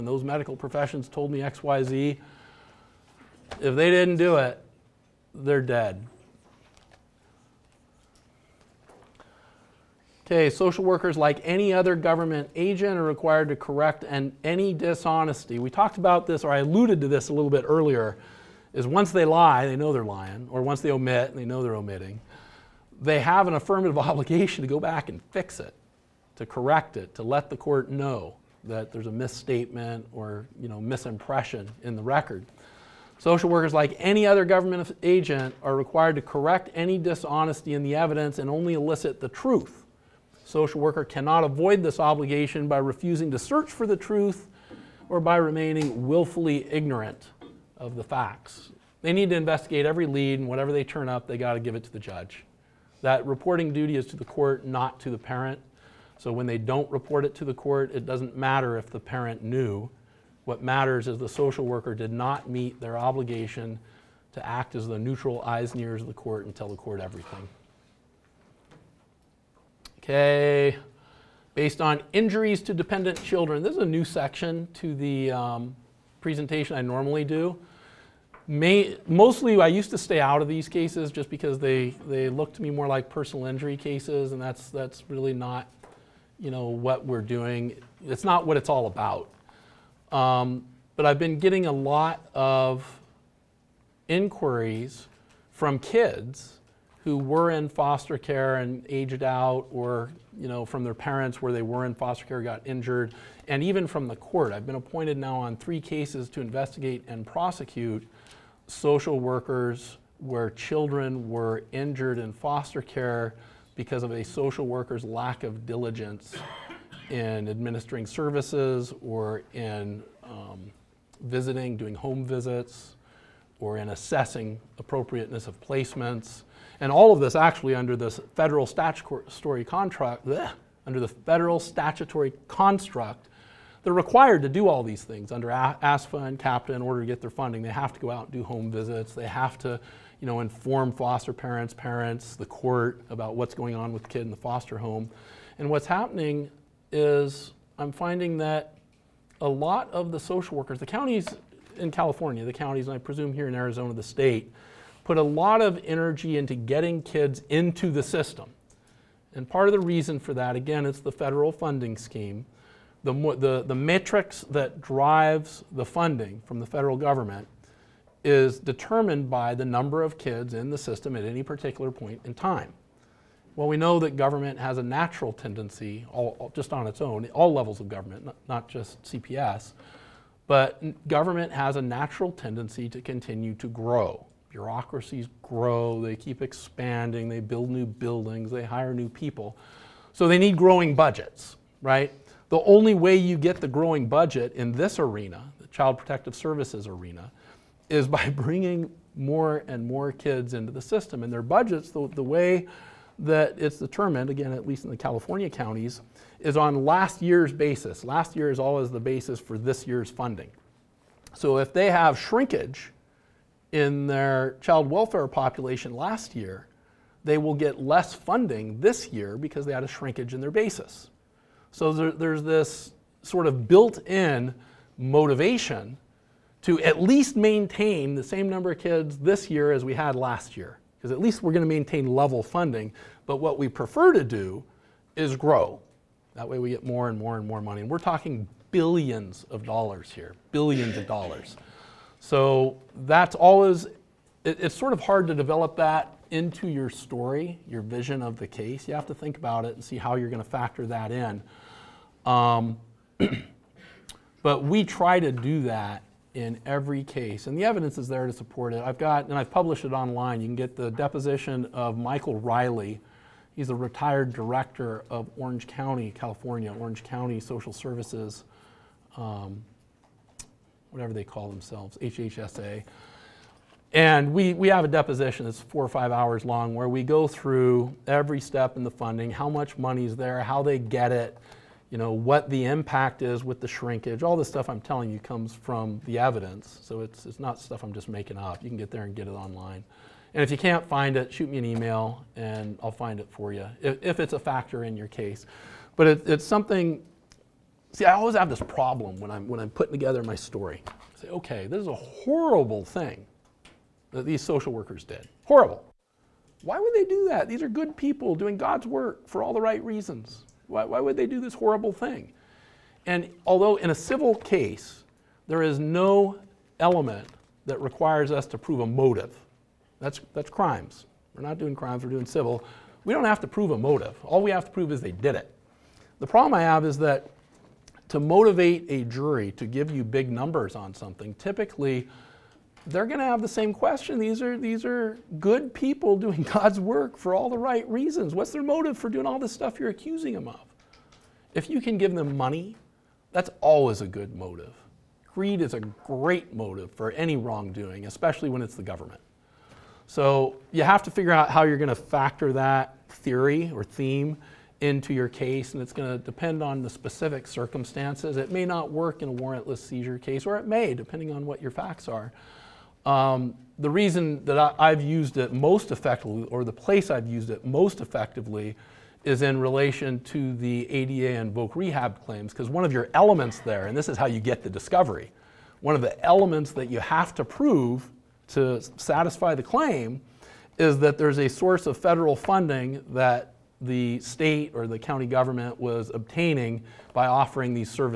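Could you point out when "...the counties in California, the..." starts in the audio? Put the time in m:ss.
2:30.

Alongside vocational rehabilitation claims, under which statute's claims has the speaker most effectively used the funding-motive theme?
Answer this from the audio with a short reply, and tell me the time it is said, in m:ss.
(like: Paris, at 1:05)
ADA, at 6:10.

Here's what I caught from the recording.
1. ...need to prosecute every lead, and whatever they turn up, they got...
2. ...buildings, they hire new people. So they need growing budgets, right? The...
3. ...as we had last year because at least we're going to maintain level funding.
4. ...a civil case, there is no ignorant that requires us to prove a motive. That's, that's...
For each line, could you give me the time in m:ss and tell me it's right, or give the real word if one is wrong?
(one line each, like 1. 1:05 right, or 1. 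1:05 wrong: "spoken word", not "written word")
1. 0:49 wrong: "investigate", not "prosecute"
2. 3:07 right
3. 3:49 right
4. 5:13 wrong: "element", not "ignorant".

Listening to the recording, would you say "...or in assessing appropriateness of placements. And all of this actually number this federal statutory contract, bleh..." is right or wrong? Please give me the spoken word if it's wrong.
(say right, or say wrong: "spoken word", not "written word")
wrong: "under", not "number".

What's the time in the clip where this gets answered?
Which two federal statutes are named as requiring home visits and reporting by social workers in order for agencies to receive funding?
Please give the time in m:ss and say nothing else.
2:15.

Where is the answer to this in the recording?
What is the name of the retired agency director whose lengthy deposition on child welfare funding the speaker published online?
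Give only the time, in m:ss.
4:21.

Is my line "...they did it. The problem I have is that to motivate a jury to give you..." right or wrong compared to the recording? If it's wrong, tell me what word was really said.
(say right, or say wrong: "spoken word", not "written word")
right.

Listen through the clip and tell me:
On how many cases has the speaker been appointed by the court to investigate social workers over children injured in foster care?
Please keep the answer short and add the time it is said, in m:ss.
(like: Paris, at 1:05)
3, at 1:45.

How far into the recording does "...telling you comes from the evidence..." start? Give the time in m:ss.
4:44.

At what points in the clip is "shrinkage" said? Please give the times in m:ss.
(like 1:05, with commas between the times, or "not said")
3:32, 3:39, 4:43.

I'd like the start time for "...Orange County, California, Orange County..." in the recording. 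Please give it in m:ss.
4:25.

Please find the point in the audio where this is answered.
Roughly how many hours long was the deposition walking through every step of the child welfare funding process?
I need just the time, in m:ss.
4:35.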